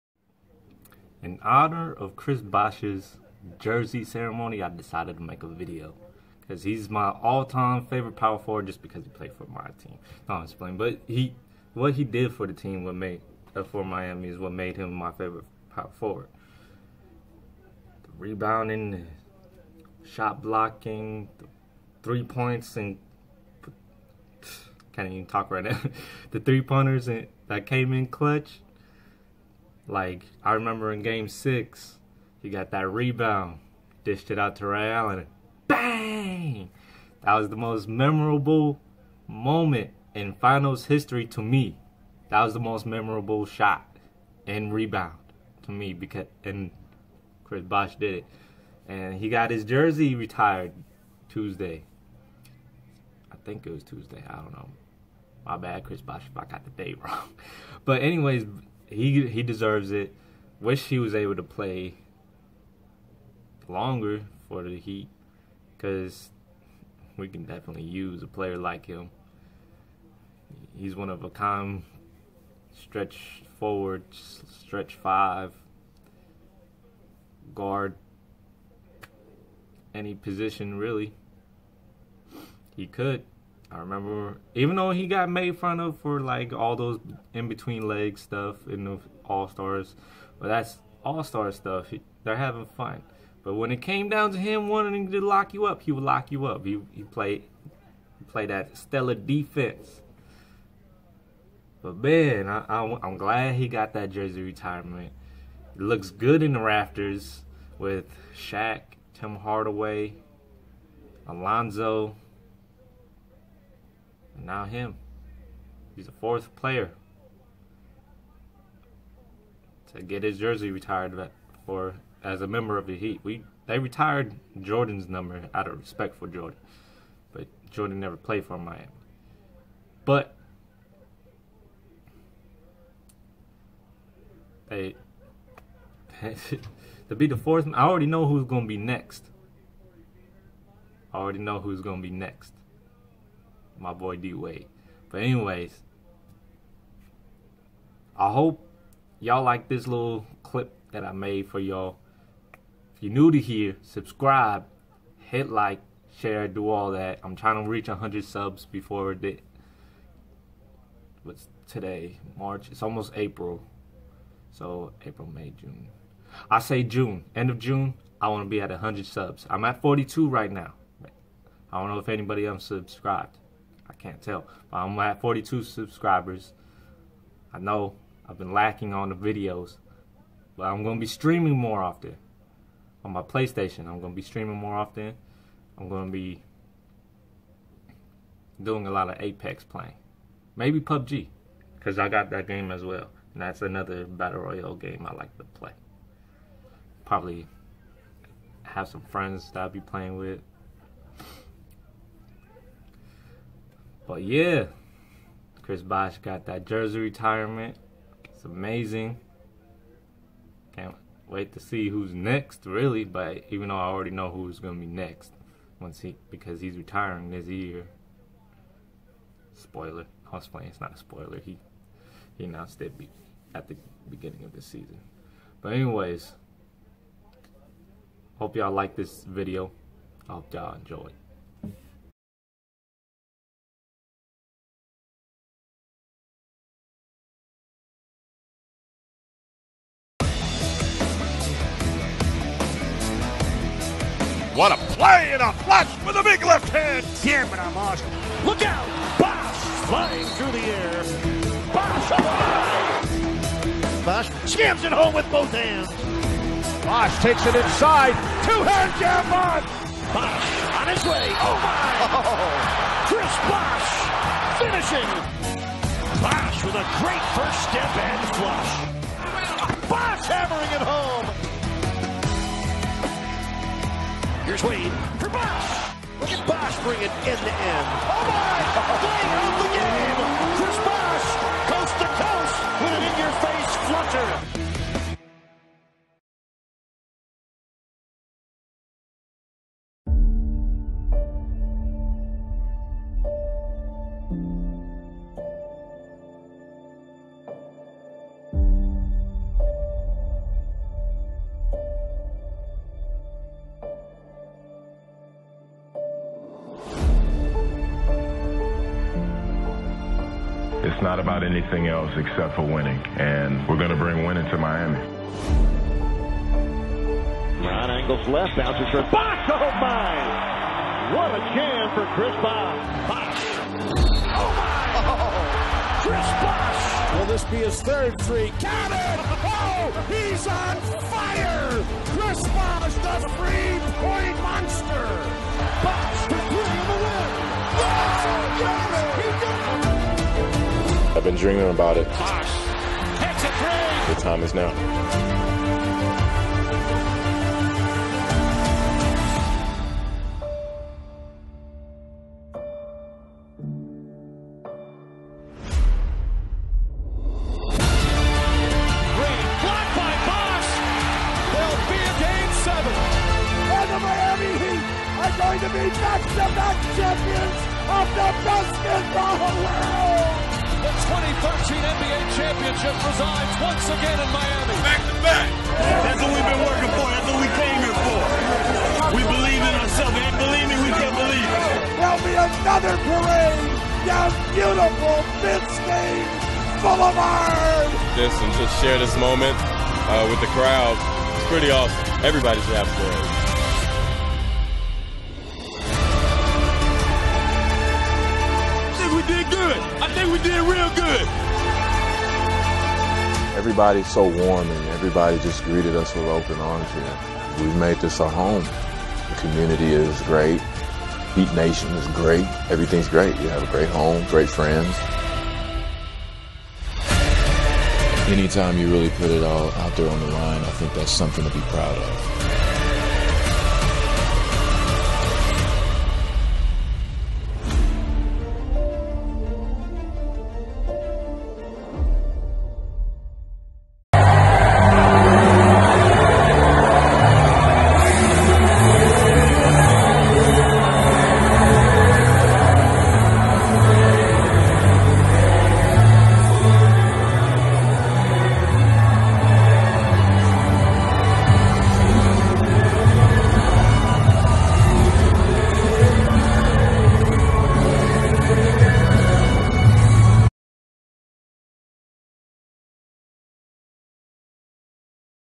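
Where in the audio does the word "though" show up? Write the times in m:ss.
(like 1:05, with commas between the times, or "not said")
1:24, 3:33.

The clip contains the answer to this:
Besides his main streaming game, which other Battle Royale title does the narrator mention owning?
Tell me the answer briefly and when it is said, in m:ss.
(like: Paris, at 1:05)
PUBG, at 3:10.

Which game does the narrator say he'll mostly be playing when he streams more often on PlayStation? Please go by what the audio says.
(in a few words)
Apex.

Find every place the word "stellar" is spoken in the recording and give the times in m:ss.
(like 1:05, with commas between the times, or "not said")
1:38.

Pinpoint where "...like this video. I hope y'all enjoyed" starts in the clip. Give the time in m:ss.
3:48.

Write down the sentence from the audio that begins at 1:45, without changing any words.
It looks good in the rafters with Shaq, Tim Hardaway, Alonzo.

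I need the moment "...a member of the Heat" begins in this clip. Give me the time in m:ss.
2:02.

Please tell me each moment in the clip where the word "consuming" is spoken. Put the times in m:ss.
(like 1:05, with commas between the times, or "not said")
not said.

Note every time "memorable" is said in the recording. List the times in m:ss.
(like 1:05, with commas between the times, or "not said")
0:37, 0:42.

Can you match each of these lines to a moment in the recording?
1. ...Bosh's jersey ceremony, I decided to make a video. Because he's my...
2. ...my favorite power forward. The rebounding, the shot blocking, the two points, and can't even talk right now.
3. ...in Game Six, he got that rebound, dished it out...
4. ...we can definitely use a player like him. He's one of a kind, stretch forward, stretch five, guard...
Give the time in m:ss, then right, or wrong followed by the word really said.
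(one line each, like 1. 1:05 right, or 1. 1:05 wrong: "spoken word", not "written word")
1. 0:02 right
2. 0:14 wrong: "three", not "two"
3. 0:30 right
4. 1:07 right.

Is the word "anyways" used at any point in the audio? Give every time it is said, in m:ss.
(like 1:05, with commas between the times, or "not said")
0:58, 2:25, 3:45.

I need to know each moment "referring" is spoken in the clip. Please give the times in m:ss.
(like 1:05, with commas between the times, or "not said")
not said.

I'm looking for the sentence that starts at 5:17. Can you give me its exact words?
Ron Angles left, bounces for Box.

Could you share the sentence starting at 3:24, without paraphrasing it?
But yeah, Chris Bosh got that jersey retirement.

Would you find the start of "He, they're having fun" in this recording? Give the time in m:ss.
1:31.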